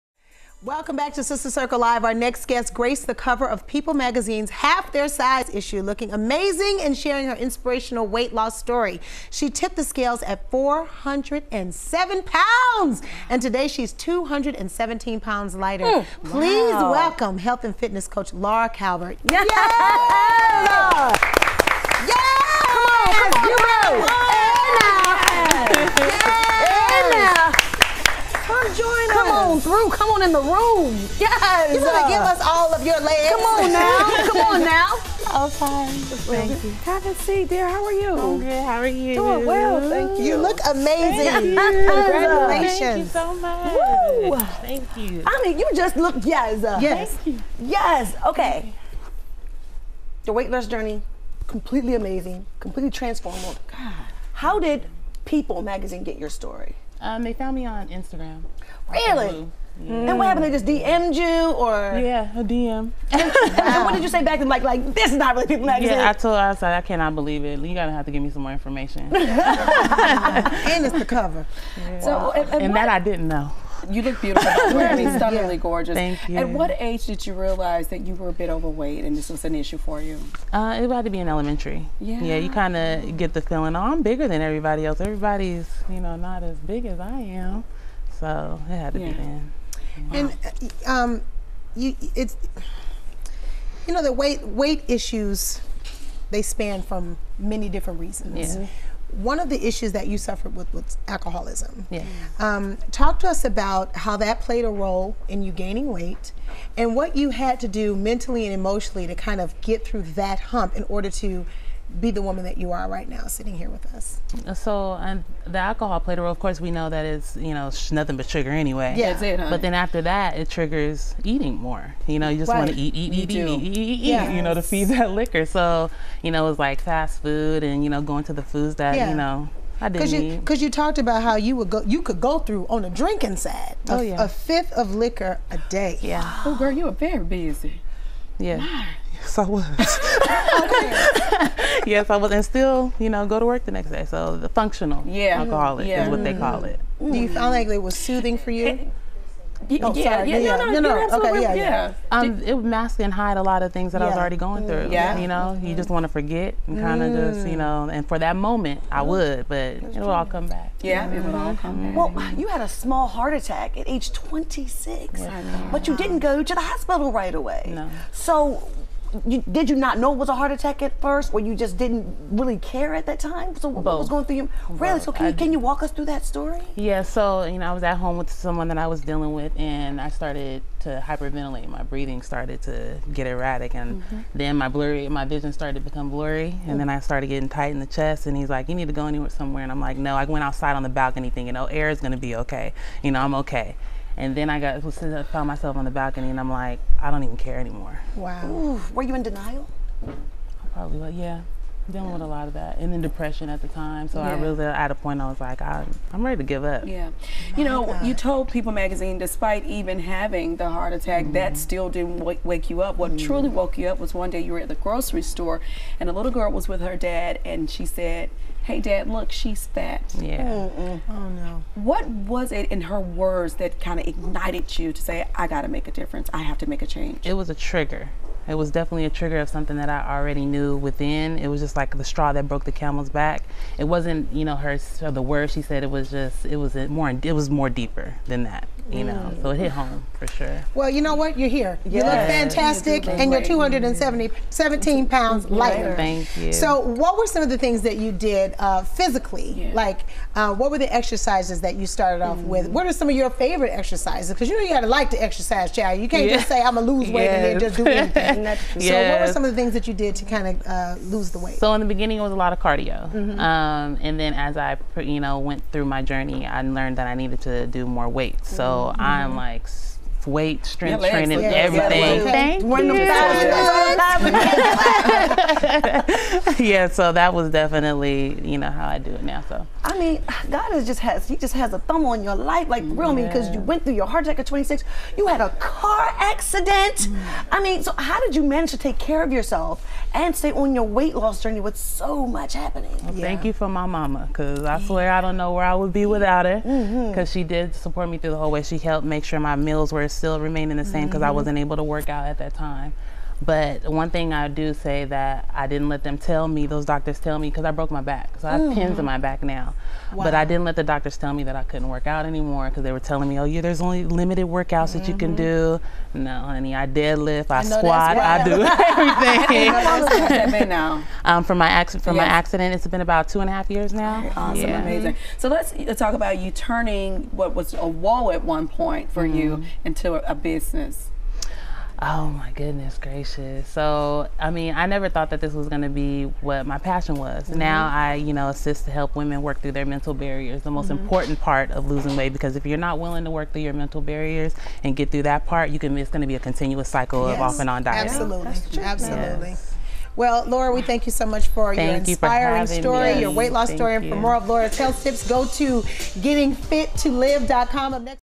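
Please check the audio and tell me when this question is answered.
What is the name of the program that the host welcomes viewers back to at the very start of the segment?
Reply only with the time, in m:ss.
0:01.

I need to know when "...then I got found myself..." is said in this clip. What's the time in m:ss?
3:14.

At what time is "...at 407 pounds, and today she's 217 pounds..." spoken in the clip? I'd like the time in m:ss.
0:10.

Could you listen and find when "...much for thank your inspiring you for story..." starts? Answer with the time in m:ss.
5:51.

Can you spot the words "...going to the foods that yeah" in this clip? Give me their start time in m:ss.
2:08.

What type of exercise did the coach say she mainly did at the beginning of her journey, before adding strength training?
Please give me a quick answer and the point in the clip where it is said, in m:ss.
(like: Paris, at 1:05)
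cardio, at 4:22.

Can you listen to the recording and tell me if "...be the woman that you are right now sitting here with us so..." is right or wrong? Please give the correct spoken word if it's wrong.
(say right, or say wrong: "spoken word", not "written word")
right.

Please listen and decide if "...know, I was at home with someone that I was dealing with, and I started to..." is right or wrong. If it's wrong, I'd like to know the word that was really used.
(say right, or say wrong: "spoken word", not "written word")
right.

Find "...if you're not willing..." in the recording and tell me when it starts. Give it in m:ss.
5:42.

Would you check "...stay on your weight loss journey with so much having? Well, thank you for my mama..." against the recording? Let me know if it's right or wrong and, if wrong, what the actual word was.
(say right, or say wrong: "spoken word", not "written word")
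wrong: "happening", not "having".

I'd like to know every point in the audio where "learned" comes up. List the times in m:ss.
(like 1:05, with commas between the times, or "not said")
4:26.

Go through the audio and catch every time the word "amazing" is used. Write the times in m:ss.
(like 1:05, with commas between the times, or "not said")
0:06, 0:40, 0:51, 5:24.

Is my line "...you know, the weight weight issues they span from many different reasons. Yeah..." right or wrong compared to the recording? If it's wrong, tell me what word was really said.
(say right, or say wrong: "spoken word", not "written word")
right.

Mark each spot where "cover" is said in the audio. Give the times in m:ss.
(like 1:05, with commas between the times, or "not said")
0:03, 1:11.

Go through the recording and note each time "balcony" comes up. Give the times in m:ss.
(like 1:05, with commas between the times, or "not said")
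3:10, 3:15.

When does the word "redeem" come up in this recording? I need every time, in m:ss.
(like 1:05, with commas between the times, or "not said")
not said.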